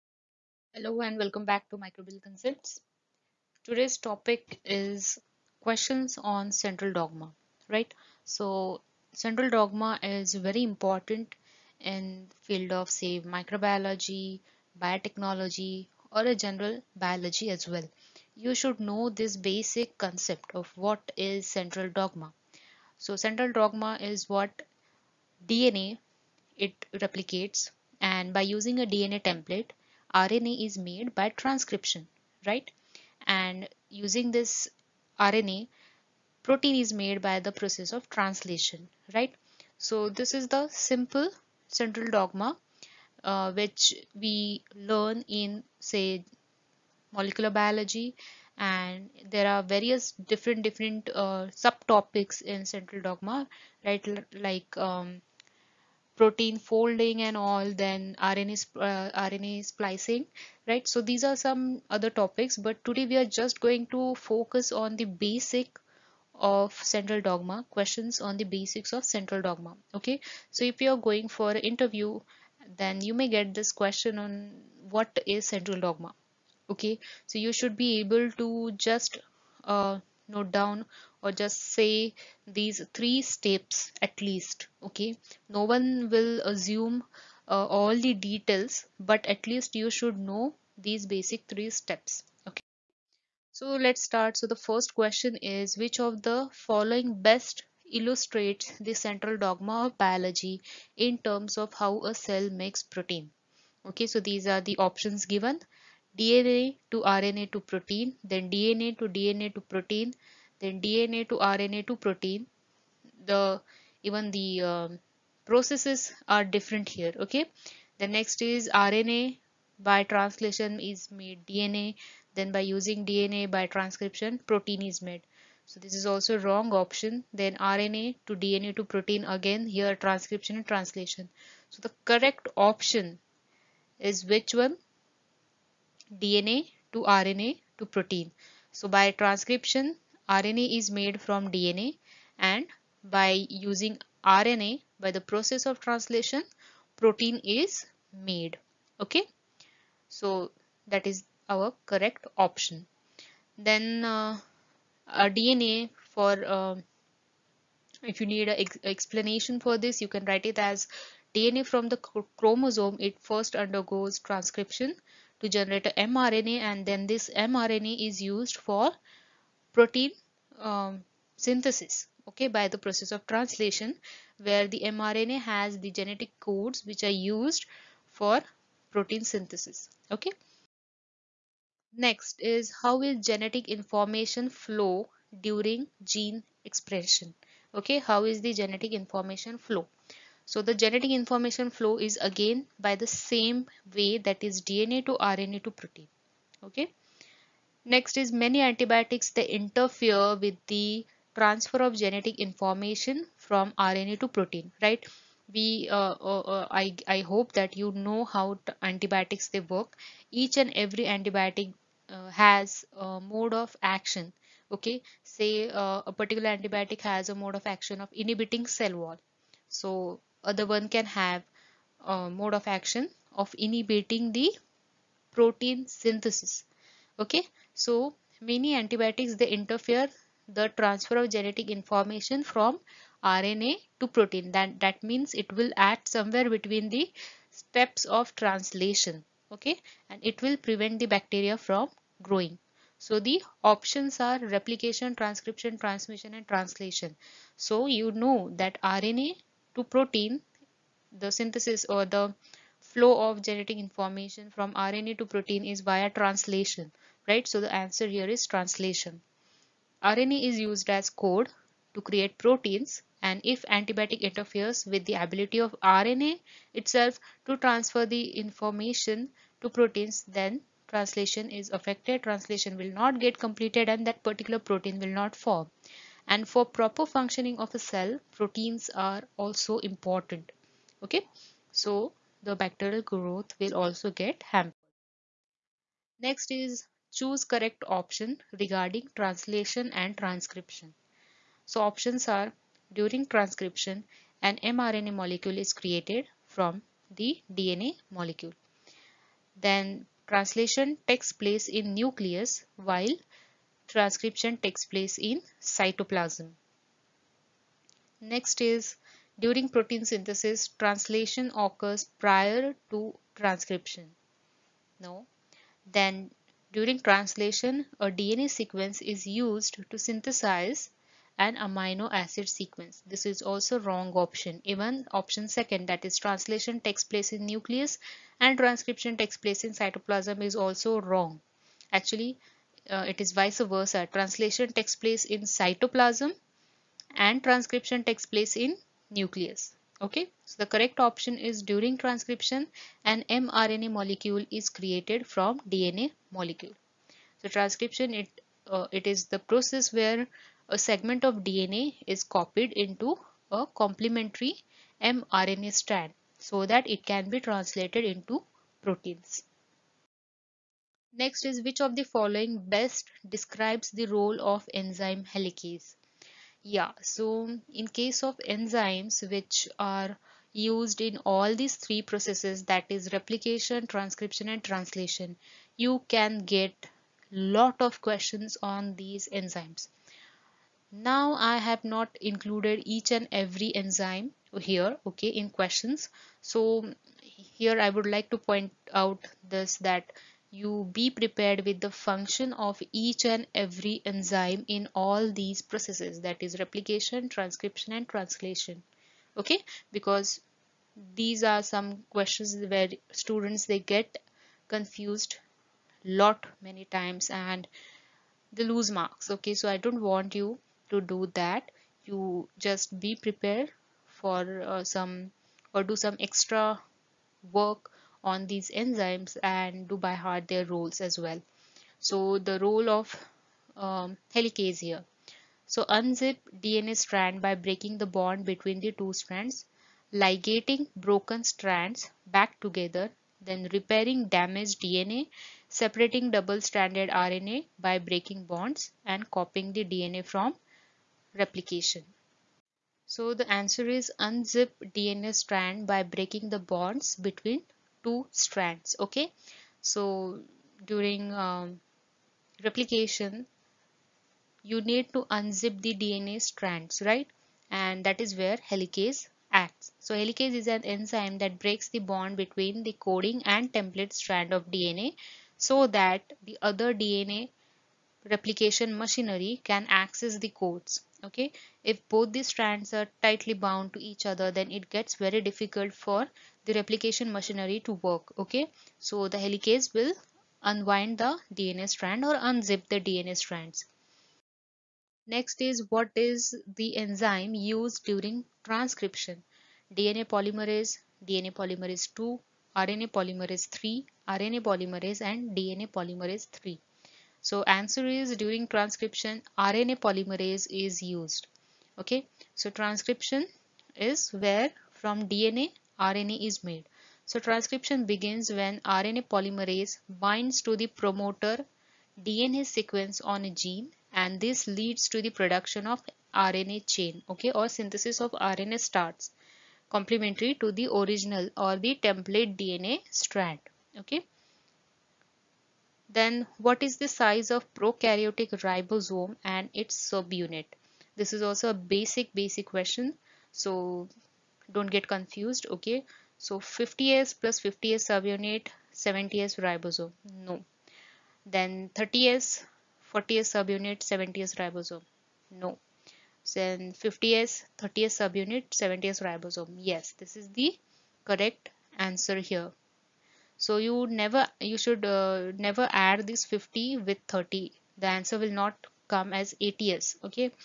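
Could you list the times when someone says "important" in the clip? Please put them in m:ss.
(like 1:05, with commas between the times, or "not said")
0:10, 4:39.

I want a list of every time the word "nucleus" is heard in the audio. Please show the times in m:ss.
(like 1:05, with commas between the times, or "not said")
5:01, 5:27, 5:39.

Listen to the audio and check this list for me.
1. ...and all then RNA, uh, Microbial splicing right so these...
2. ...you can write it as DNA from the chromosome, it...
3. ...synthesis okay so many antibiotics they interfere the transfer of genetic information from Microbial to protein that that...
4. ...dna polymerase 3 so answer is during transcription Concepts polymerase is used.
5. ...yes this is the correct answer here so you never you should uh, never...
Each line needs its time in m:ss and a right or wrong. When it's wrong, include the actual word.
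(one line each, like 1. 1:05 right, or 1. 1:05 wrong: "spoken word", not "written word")
1. 0:57 wrong: "RNA", not "Microbial"
2. 2:40 right
3. 3:45 wrong: "RNA", not "Microbial"
4. 8:15 wrong: "RNA", not "Concepts"
5. 9:09 right.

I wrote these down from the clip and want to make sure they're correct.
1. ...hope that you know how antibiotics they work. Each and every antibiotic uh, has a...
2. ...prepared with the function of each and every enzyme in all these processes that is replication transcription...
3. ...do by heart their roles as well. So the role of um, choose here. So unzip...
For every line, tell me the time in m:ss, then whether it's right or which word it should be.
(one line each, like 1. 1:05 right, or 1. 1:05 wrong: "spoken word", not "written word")
1. 3:27 right
2. 6:31 right
3. 6:59 wrong: "helicase", not "choose".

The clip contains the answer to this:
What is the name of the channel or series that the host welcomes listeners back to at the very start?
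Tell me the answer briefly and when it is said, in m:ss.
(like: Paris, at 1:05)
Microbial Concepts, at 0:01.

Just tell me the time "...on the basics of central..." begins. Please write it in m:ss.
1:08.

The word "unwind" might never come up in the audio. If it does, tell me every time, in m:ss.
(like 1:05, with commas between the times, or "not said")
8:00.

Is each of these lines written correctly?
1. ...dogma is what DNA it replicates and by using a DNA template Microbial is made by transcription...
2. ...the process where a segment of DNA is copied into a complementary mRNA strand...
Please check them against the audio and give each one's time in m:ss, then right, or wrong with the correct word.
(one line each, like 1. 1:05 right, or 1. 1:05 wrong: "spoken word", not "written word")
1. 0:23 wrong: "RNA", not "Microbial"
2. 5:49 right.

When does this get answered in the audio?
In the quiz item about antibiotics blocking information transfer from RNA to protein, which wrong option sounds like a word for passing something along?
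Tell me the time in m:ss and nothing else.
4:05.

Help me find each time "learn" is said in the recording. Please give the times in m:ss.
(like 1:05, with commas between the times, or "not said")
0:44.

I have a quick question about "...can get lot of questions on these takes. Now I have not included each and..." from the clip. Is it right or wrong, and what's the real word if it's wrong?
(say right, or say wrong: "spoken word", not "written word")
wrong: "enzymes", not "takes".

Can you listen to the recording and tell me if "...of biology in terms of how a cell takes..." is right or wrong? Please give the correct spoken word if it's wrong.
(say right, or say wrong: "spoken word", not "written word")
wrong: "makes", not "takes".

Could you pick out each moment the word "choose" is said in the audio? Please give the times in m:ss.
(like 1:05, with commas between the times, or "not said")
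4:47.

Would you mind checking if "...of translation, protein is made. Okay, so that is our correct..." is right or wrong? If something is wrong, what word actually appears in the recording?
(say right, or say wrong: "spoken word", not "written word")
right.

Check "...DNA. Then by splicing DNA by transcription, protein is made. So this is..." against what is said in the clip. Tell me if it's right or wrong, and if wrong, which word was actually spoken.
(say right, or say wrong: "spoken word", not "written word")
wrong: "using", not "splicing".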